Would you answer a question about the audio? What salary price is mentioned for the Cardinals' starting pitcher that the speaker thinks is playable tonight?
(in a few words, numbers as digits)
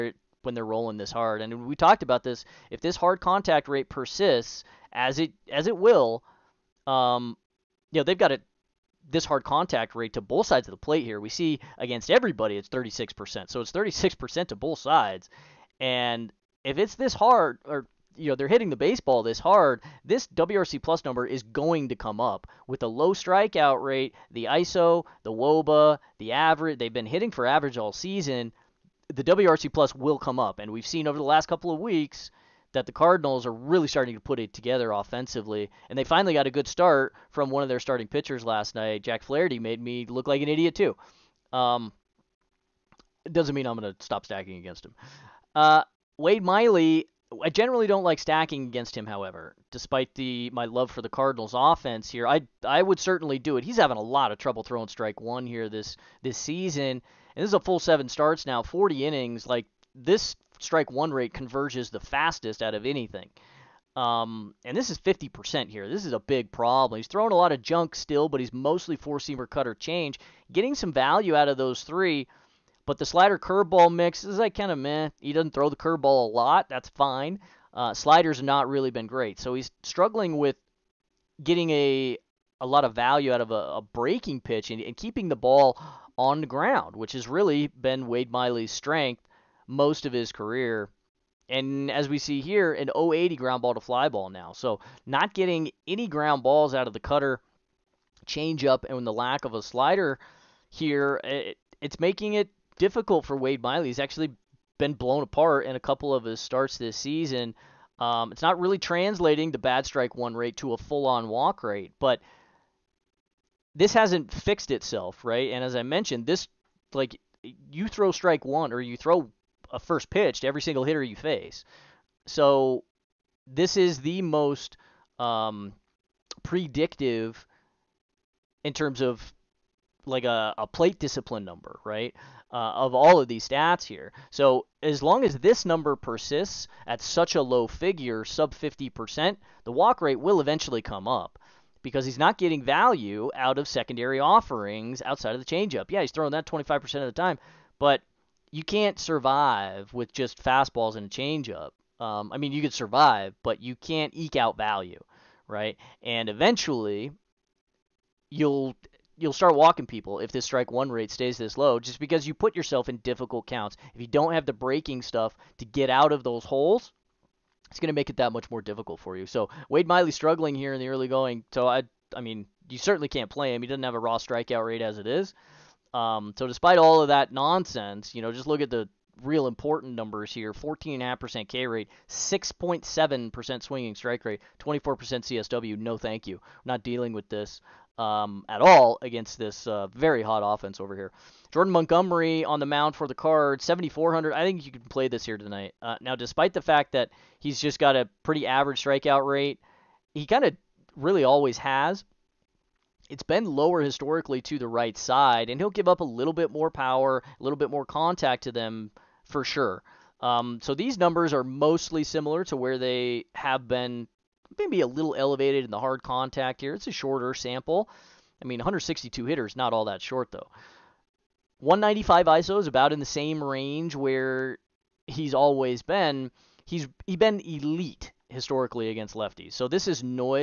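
7,400.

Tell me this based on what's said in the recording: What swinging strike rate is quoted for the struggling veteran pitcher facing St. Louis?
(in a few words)
6.7%.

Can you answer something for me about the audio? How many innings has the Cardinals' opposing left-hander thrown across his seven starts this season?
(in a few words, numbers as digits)
40.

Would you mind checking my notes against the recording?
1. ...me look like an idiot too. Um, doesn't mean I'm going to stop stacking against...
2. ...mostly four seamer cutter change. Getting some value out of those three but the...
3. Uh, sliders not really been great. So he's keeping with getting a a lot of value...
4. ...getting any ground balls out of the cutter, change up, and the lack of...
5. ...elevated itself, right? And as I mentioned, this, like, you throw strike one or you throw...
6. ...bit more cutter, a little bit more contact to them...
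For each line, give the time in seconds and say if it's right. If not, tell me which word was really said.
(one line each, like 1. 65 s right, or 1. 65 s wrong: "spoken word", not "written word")
1. 39 s right
2. 68 s right
3. 77 s wrong: "struggling", not "keeping"
4. 95 s right
5. 114 s wrong: "fixed", not "elevated"
6. 206 s wrong: "power", not "cutter".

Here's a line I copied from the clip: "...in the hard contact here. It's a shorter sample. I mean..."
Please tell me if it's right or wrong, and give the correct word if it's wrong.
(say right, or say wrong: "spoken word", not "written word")
right.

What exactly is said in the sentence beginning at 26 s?
They've been hitting for average all season.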